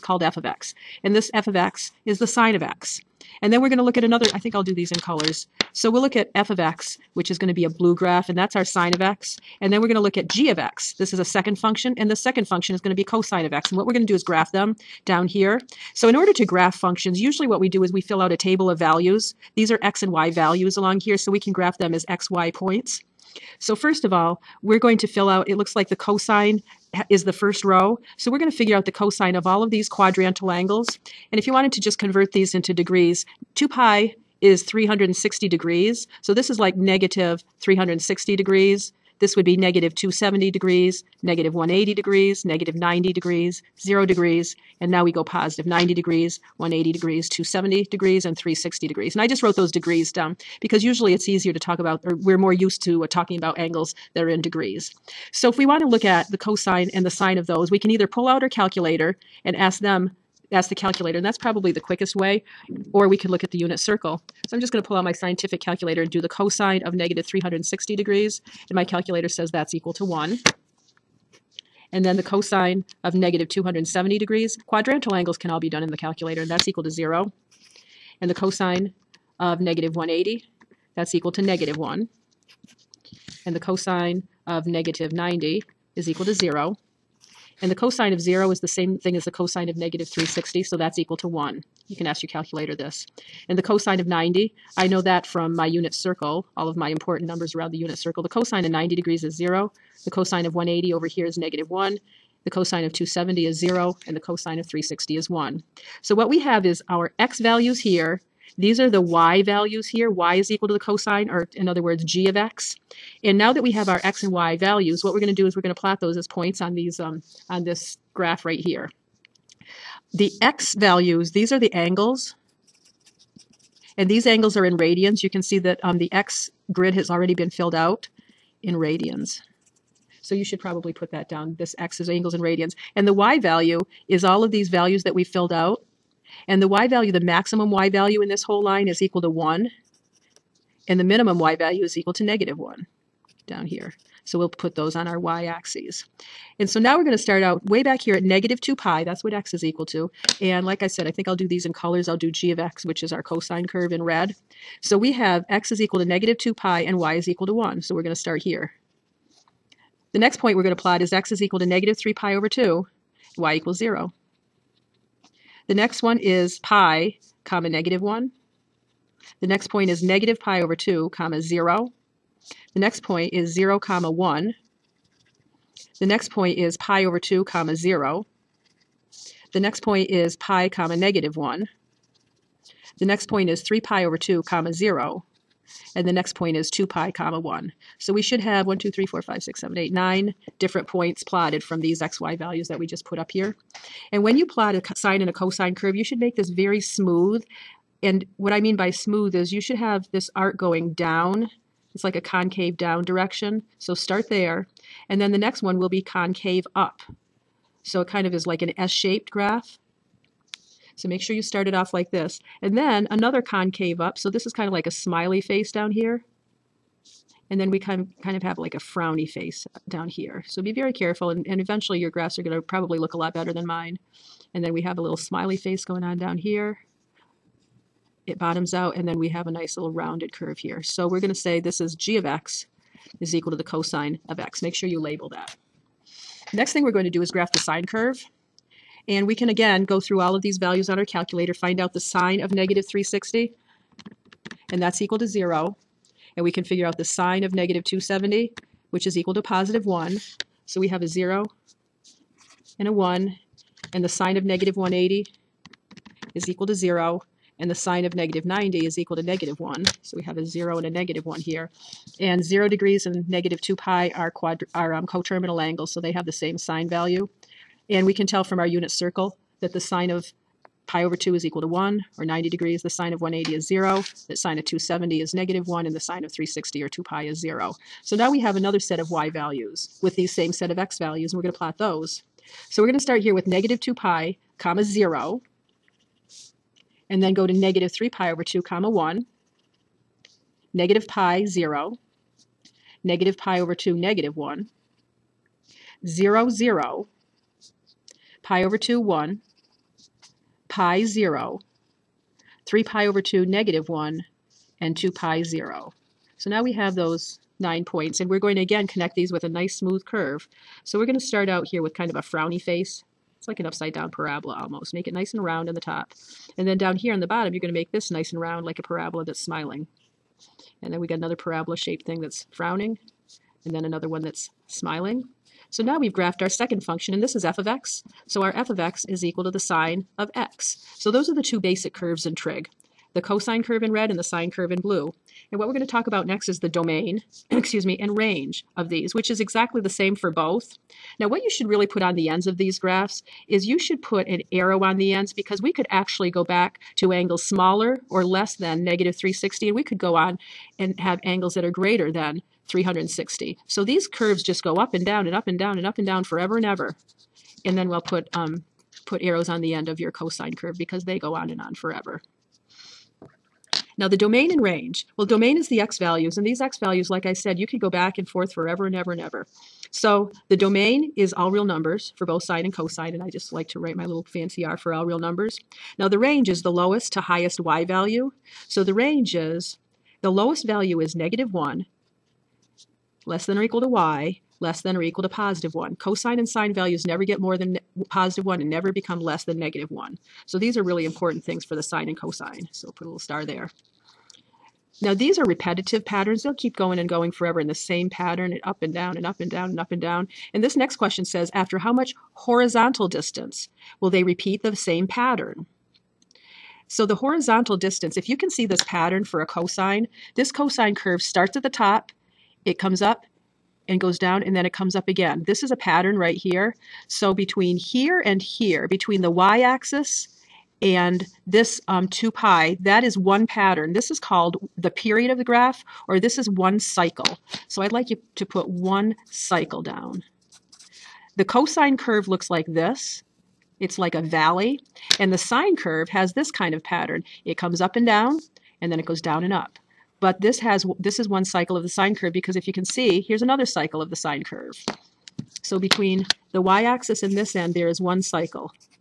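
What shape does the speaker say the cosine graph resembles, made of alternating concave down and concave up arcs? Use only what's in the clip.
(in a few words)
S-shaped.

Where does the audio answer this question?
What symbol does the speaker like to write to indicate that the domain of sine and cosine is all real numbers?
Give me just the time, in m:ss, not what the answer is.
6:14.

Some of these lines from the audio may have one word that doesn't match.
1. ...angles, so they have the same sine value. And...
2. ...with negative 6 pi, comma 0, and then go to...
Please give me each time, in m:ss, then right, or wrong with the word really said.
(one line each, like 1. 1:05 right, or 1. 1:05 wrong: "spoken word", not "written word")
1. 4:25 right
2. 4:43 wrong: "2", not "6".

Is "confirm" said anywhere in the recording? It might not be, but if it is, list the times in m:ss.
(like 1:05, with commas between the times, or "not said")
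not said.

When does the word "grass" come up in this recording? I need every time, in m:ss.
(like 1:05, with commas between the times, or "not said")
not said.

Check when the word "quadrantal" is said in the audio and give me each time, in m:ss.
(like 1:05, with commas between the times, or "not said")
0:29, 1:14.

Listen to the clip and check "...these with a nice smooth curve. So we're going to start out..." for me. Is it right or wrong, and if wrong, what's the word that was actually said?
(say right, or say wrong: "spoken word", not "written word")
right.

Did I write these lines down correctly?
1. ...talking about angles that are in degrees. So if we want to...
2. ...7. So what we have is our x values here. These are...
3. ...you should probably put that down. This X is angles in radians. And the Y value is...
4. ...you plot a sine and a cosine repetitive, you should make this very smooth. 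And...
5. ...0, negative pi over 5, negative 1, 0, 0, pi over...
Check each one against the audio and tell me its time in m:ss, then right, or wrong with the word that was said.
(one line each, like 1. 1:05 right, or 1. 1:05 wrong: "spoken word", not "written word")
1. 0:53 right
2. 1:45 wrong: "1", not "7"
3. 2:10 right
4. 3:14 wrong: "curve", not "repetitive"
5. 4:51 wrong: "2", not "5".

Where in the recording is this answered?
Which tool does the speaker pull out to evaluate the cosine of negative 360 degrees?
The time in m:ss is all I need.
1:05.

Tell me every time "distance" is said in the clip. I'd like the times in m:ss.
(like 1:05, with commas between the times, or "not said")
6:43, 6:47.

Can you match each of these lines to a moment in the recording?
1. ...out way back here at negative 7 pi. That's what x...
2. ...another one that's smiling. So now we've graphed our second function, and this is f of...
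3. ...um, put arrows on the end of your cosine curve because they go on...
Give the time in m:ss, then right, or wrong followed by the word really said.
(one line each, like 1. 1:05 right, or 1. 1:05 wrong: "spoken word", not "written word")
1. 2:27 wrong: "2", not "7"
2. 5:23 right
3. 5:58 right.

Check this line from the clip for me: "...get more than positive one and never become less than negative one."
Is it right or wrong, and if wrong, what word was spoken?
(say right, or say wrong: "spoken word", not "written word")
right.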